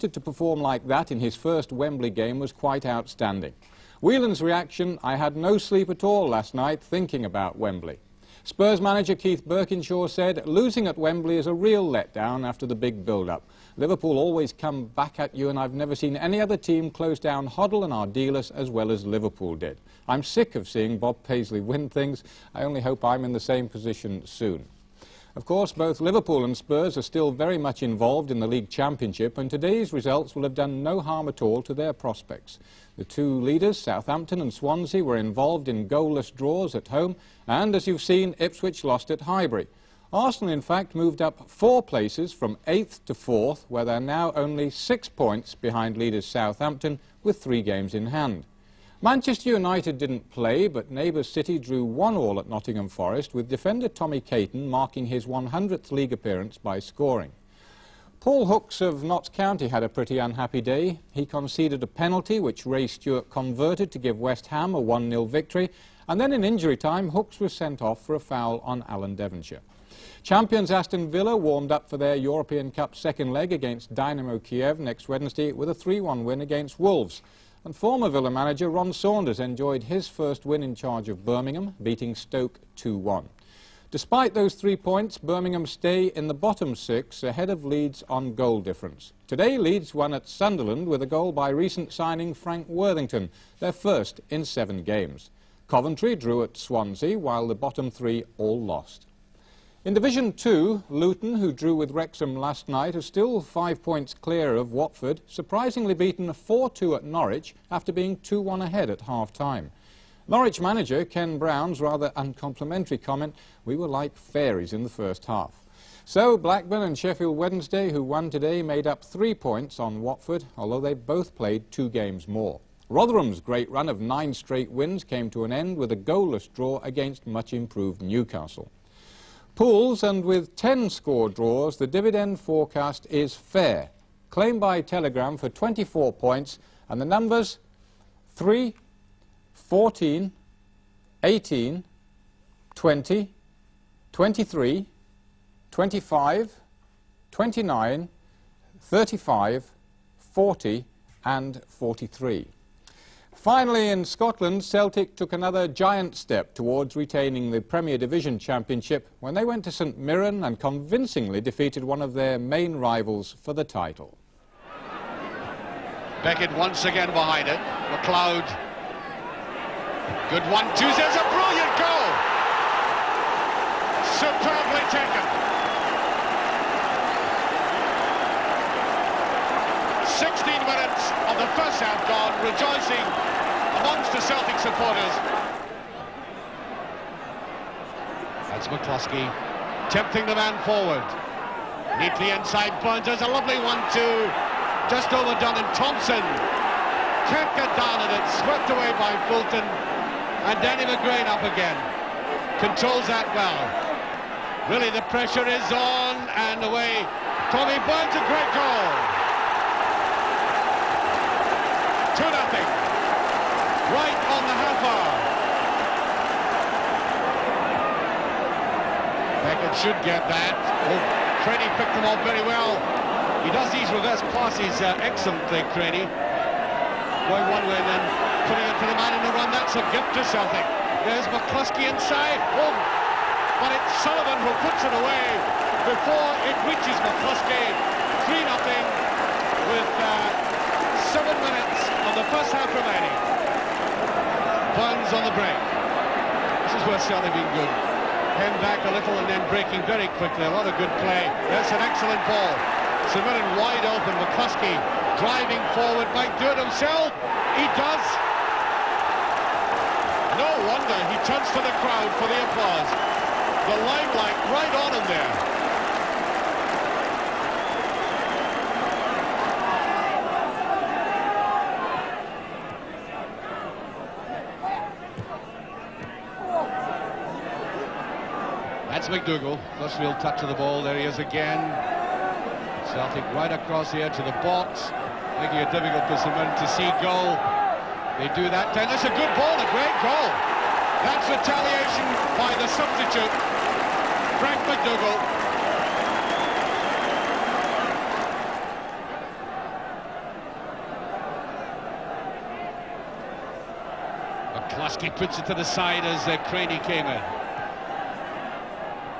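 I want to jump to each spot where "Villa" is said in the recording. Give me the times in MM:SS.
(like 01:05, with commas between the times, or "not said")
01:11, 01:18.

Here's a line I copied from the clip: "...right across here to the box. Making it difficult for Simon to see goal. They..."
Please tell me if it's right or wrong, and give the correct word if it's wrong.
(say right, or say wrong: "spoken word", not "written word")
right.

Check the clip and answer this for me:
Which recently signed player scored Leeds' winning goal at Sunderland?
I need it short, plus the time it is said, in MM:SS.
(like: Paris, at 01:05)
Frank Worthington, at 01:32.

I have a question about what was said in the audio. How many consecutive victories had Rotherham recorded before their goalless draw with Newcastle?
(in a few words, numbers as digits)
9.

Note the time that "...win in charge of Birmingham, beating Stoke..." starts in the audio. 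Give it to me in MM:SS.
01:20.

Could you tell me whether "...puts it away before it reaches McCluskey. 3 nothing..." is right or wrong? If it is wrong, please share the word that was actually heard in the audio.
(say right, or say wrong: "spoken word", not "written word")
right.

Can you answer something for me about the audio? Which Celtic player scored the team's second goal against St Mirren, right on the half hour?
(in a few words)
Tommy Burns.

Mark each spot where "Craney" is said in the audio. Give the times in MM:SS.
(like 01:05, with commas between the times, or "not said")
03:41, 03:45, 05:06.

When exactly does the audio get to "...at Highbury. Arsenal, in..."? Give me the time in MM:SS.
00:39.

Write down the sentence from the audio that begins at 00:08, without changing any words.
Spurs manager Keith Burkinshaw said, losing at Wembley is a real letdown after the big build-up.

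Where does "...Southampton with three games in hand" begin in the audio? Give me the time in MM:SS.
00:46.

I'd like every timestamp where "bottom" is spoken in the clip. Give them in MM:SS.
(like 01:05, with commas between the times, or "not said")
01:26, 01:37.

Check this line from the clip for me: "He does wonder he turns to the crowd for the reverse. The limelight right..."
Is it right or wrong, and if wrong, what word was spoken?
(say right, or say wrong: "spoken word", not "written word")
wrong: "applause", not "reverse".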